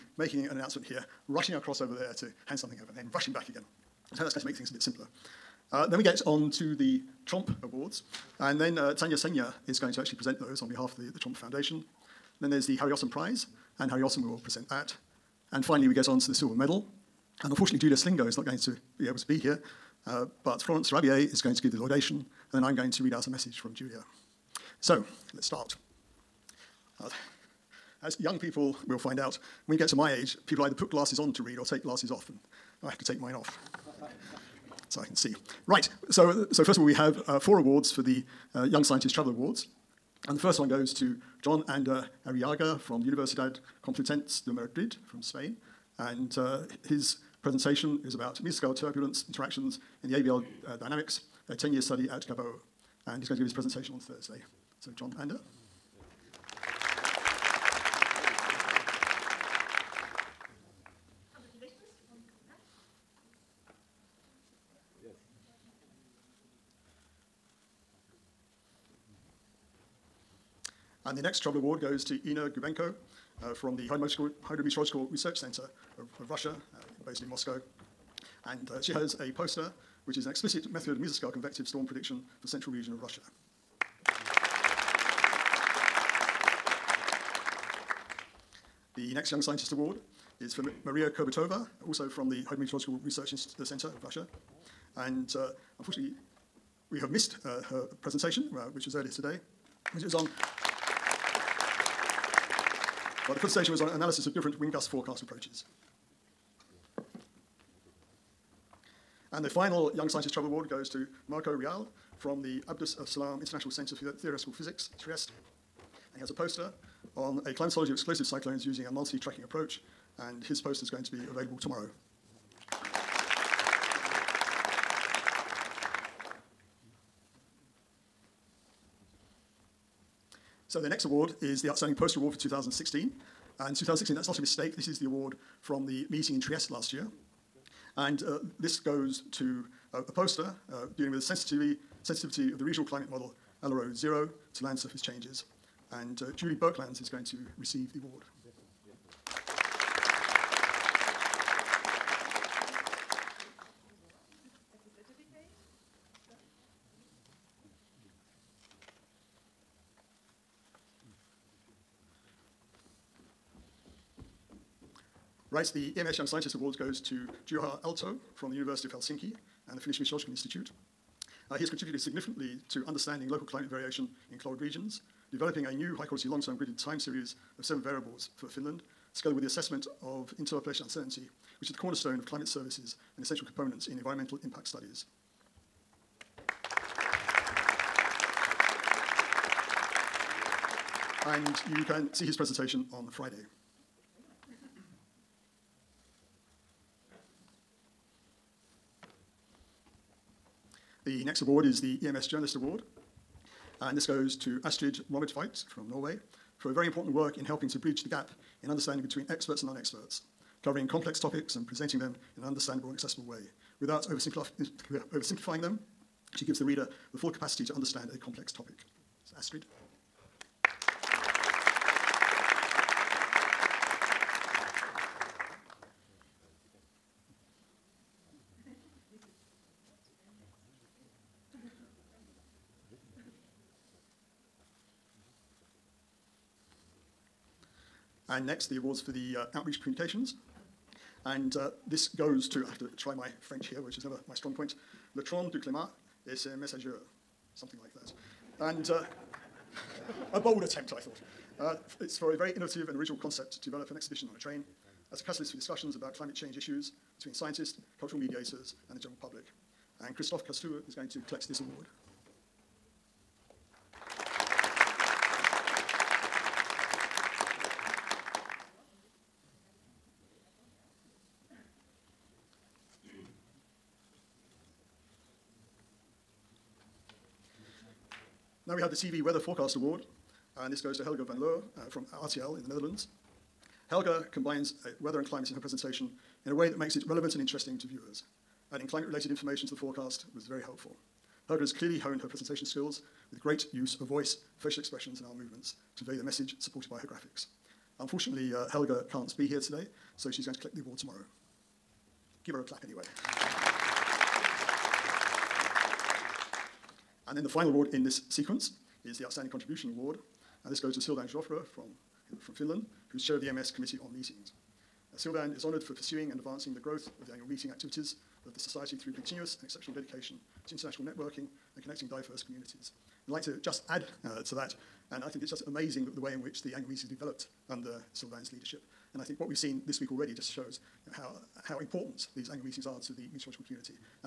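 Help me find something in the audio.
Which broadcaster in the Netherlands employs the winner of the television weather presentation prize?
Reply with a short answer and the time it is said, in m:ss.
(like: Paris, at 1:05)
RTL, at 4:42.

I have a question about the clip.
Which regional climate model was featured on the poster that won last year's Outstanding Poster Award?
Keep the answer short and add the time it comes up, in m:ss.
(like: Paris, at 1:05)
ALARO-0, at 2:23.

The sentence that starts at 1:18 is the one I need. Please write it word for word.
And uh, she has a poster, which is an explicit method of mesoscale convective storm prediction for central region of Russia.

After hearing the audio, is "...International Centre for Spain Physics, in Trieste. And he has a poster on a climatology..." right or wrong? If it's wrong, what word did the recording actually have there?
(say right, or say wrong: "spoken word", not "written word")
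wrong: "Theoretical", not "Spain".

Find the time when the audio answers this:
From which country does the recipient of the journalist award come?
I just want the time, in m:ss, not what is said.
3:25.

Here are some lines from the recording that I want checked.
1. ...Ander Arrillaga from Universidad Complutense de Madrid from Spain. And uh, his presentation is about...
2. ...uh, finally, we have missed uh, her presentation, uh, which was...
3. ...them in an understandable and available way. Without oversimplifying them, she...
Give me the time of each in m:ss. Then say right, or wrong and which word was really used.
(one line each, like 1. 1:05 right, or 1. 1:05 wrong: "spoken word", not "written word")
1. 0:41 right
2. 1:35 wrong: "unfortunately", not "finally"
3. 3:31 wrong: "accessible", not "available".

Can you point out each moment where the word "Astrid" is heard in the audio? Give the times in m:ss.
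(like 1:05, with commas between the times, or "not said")
3:24, 3:39.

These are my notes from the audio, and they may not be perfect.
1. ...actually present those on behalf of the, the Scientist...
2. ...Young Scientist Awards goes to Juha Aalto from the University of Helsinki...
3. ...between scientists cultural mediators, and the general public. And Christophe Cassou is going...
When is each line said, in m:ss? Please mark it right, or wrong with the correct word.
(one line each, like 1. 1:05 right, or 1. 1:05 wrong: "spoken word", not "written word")
1. 0:09 wrong: "Tromp", not "Scientist"
2. 2:46 right
3. 4:17 right.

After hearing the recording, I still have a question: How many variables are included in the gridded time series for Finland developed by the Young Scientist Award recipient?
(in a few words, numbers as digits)
7.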